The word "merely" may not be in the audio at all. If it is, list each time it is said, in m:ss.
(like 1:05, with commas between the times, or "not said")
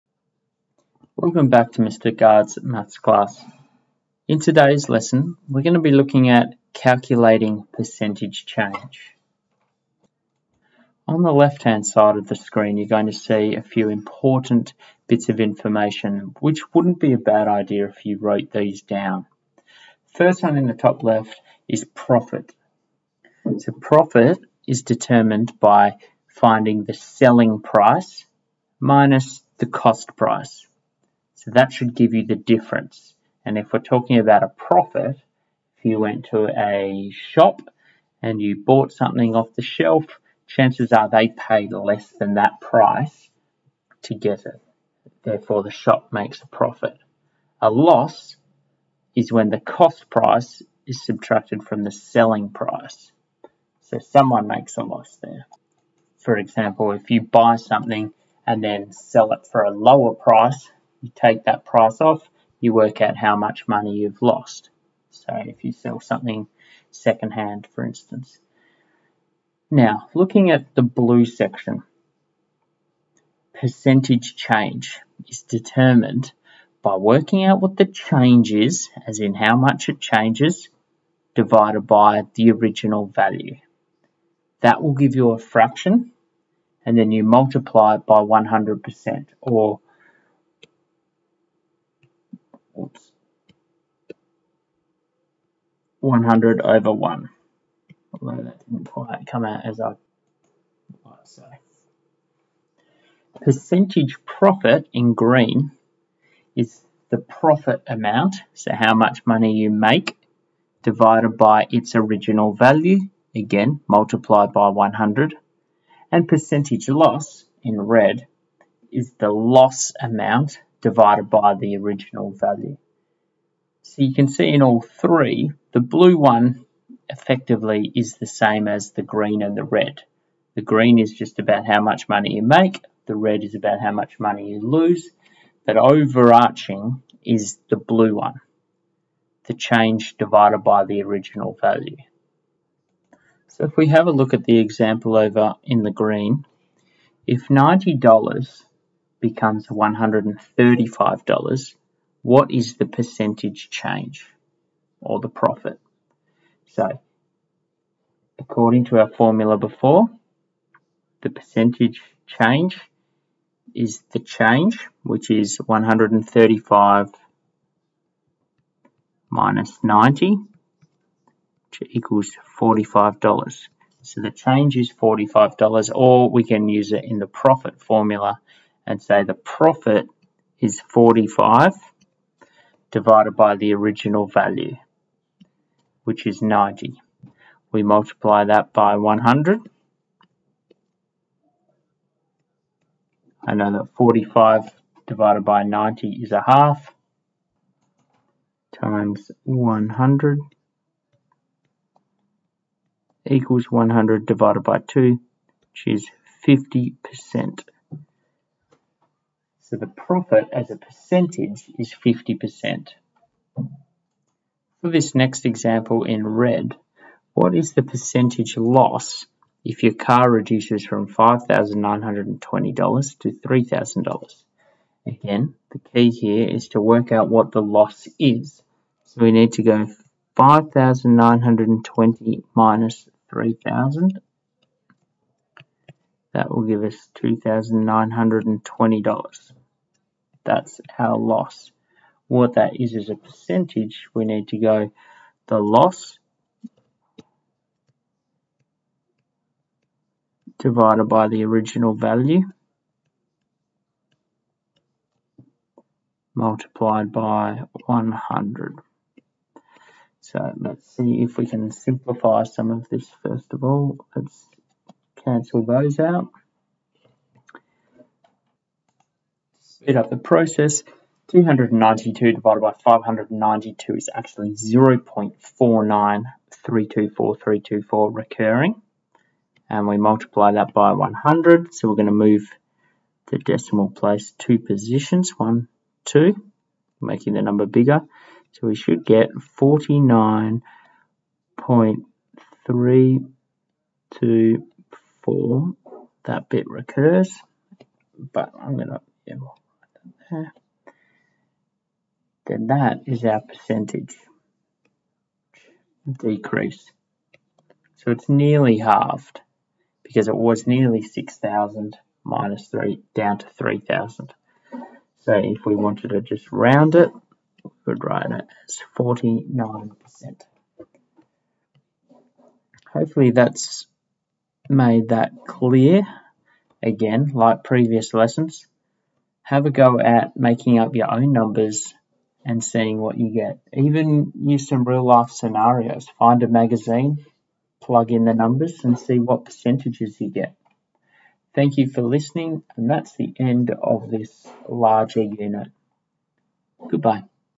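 not said.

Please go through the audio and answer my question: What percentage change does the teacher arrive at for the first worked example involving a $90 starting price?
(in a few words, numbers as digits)
50%.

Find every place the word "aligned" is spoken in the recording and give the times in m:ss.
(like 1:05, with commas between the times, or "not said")
not said.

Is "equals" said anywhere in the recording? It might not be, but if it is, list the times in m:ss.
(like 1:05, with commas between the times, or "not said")
2:51, 3:23.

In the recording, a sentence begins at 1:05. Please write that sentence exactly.
So if you sell something secondhand, for instance.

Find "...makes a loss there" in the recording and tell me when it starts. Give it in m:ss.
0:54.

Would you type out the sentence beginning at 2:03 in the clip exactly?
So you can see in all three, the blue one effectively is the same as the green and the red.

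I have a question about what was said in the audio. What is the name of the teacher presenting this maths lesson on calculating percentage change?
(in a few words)
Mr. Gard.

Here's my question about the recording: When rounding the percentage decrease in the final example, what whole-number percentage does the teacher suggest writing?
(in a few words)
49%.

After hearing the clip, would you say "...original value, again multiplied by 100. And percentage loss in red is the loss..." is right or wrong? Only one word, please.
right.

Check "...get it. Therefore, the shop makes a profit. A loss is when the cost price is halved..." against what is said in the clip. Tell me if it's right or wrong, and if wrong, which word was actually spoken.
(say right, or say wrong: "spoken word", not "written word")
wrong: "subtracted", not "halved".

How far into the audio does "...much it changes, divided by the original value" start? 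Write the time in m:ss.
1:19.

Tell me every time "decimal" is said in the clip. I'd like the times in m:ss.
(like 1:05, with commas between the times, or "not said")
4:43.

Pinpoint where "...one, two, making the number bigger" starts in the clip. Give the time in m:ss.
4:45.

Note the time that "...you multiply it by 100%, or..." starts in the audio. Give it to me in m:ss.
1:27.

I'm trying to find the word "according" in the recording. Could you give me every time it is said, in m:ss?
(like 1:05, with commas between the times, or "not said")
2:38.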